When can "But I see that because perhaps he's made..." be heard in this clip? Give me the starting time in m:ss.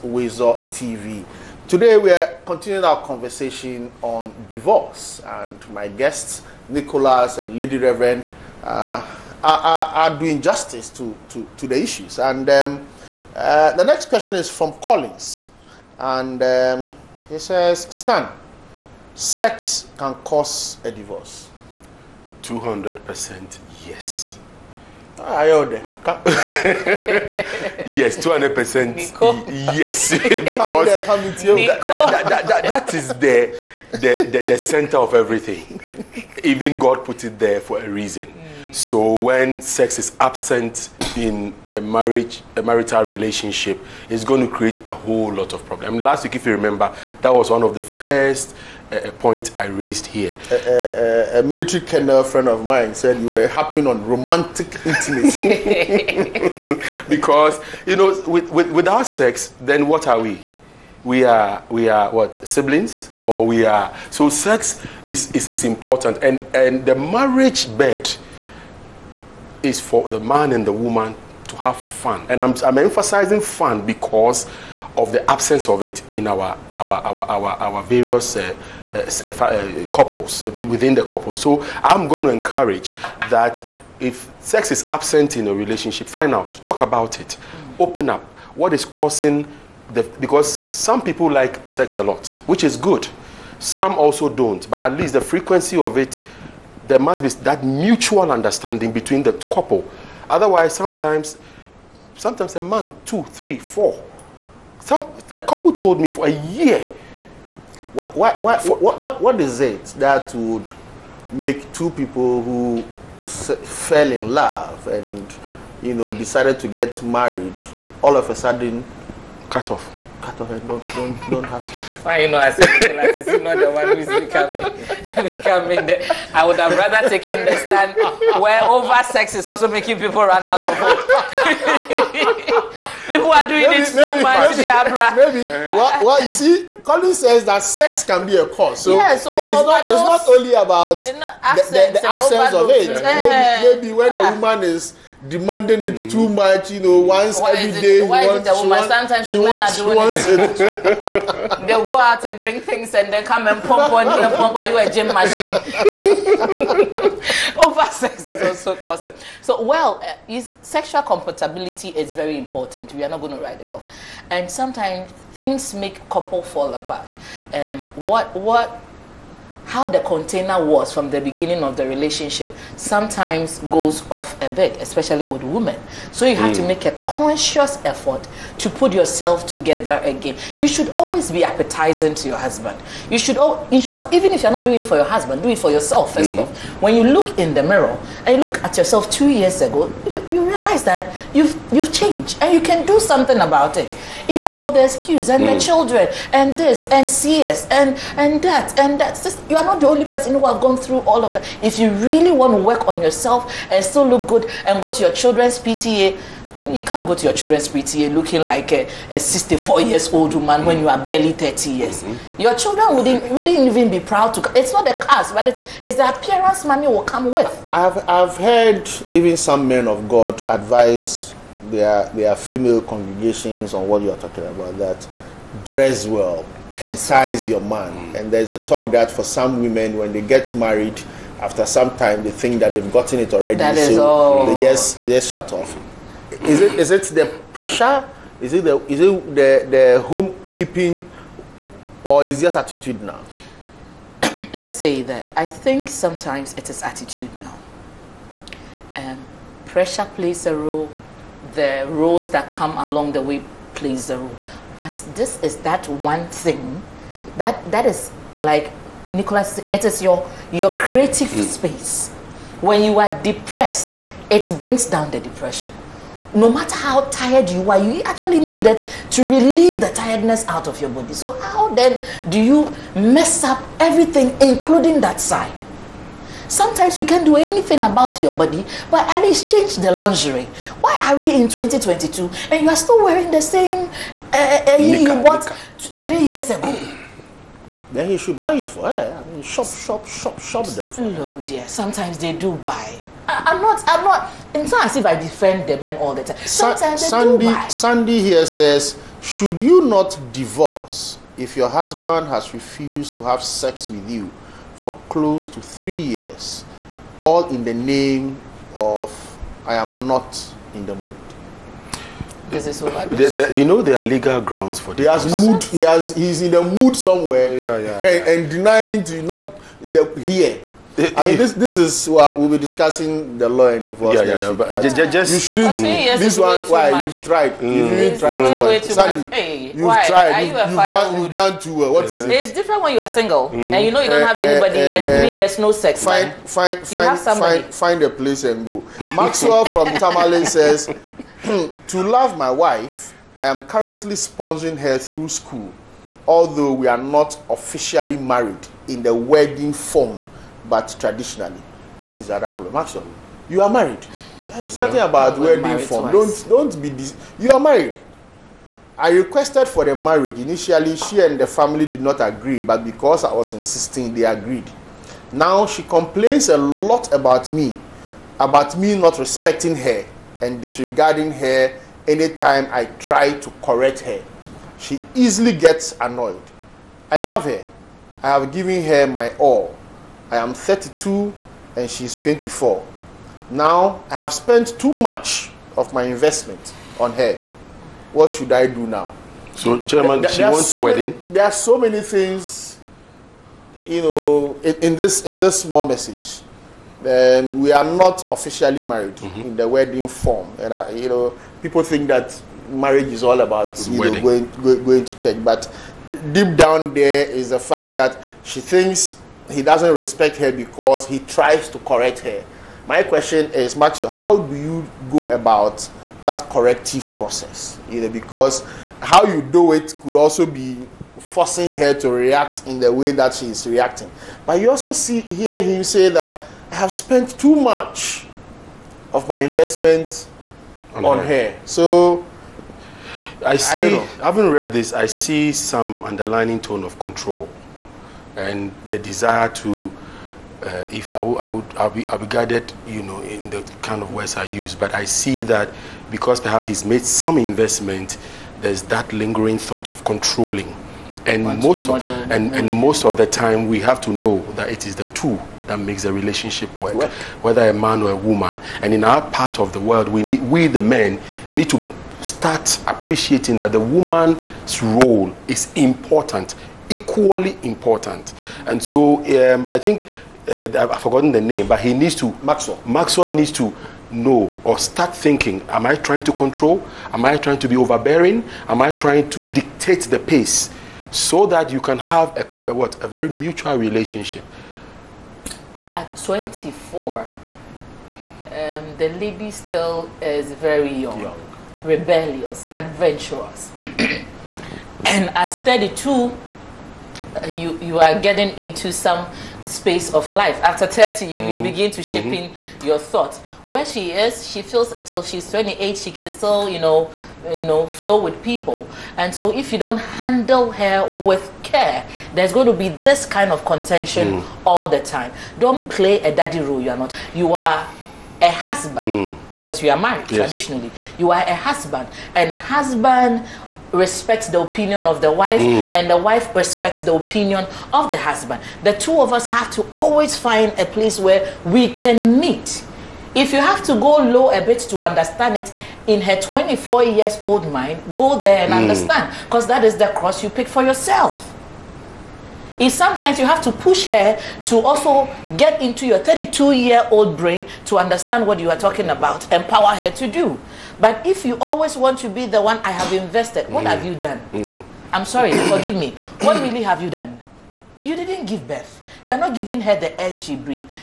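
7:24.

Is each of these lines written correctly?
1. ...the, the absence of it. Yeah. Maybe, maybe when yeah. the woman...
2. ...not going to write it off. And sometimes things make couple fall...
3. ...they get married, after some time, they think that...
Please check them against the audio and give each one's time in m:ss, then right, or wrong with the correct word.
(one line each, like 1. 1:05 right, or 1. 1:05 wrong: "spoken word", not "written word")
1. 2:21 right
2. 2:43 right
3. 3:50 right.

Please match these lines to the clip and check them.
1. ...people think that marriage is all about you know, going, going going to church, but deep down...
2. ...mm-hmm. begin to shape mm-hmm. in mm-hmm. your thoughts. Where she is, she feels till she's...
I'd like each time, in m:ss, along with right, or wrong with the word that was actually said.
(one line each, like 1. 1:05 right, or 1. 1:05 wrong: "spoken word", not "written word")
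1. 6:41 right
2. 8:21 right.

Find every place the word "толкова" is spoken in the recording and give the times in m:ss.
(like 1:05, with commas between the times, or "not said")
not said.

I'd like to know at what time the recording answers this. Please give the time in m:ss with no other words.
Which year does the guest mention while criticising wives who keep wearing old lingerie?
4:41.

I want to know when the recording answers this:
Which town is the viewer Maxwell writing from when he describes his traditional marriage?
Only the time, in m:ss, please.
5:39.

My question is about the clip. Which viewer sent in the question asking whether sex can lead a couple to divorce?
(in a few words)
Collins.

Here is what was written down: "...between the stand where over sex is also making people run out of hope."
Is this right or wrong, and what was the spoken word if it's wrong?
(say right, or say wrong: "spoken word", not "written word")
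wrong: "taken", not "between".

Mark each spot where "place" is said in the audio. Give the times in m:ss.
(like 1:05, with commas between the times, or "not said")
5:38, 8:50.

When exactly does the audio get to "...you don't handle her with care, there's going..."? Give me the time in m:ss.
8:29.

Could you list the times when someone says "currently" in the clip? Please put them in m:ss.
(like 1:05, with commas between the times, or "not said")
5:43.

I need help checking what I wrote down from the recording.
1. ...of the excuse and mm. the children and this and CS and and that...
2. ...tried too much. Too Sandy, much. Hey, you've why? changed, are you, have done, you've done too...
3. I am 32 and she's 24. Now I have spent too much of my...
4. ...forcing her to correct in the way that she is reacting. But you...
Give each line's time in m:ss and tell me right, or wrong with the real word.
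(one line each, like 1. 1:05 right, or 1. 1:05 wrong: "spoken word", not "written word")
1. 3:14 right
2. 5:28 wrong: "tried", not "changed"
3. 6:20 right
4. 7:01 wrong: "react", not "correct".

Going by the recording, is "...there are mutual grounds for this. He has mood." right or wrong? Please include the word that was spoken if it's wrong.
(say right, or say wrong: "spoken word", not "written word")
wrong: "legal", not "mutual".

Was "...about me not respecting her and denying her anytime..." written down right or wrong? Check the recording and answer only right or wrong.
wrong.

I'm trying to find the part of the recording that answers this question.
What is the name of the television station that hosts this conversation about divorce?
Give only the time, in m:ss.
0:00.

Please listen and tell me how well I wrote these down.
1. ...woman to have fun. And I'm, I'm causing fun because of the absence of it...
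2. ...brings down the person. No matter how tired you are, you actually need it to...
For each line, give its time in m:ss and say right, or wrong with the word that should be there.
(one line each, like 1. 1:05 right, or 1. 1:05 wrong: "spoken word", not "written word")
1. 1:10 wrong: "emphasizing", not "causing"
2. 4:24 wrong: "depression", not "person".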